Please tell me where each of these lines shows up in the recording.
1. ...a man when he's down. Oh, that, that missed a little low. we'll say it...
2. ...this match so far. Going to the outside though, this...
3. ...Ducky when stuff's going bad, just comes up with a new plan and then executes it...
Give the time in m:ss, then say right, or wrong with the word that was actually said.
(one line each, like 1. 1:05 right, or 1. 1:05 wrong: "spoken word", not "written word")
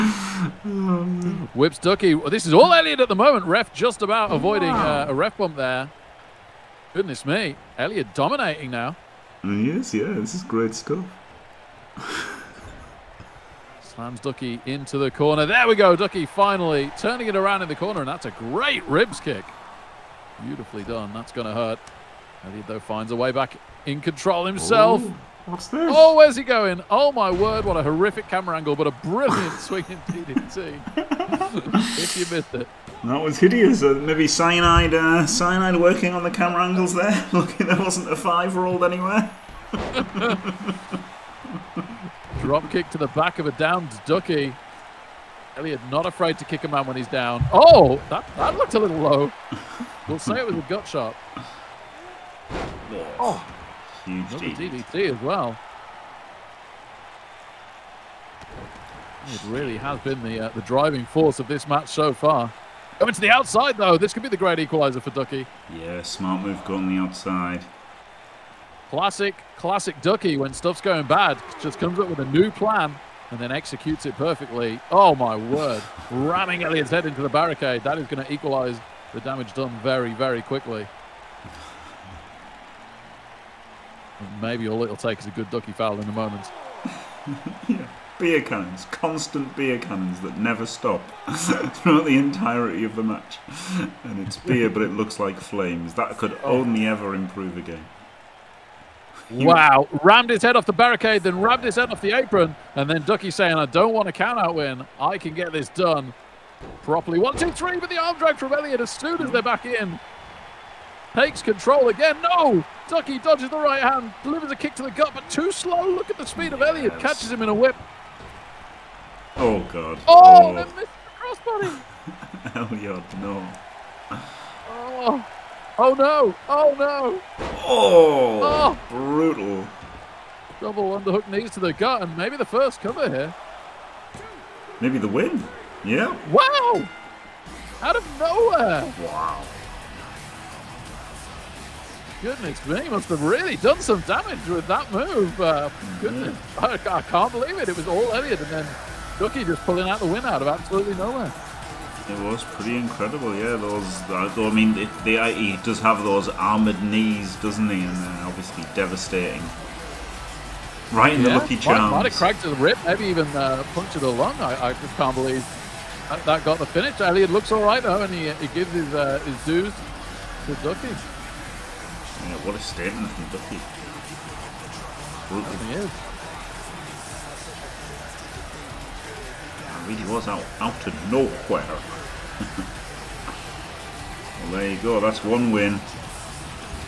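1. 0:46 wrong: "looked", not "missed"
2. 1:01 right
3. 1:10 right.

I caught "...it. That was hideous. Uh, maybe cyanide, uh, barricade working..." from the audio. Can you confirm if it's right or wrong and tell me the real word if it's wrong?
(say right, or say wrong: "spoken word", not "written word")
wrong: "cyanide", not "barricade".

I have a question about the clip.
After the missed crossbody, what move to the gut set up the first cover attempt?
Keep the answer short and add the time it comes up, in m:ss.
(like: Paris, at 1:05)
Double underhook knees, at 2:10.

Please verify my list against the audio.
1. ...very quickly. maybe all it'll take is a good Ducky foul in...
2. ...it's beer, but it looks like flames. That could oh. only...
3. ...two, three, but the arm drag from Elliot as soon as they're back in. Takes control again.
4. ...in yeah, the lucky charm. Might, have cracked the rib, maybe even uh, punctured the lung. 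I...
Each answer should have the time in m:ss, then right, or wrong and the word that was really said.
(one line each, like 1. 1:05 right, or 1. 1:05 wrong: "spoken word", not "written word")
1. 1:20 right
2. 1:34 right
3. 1:47 right
4. 2:41 right.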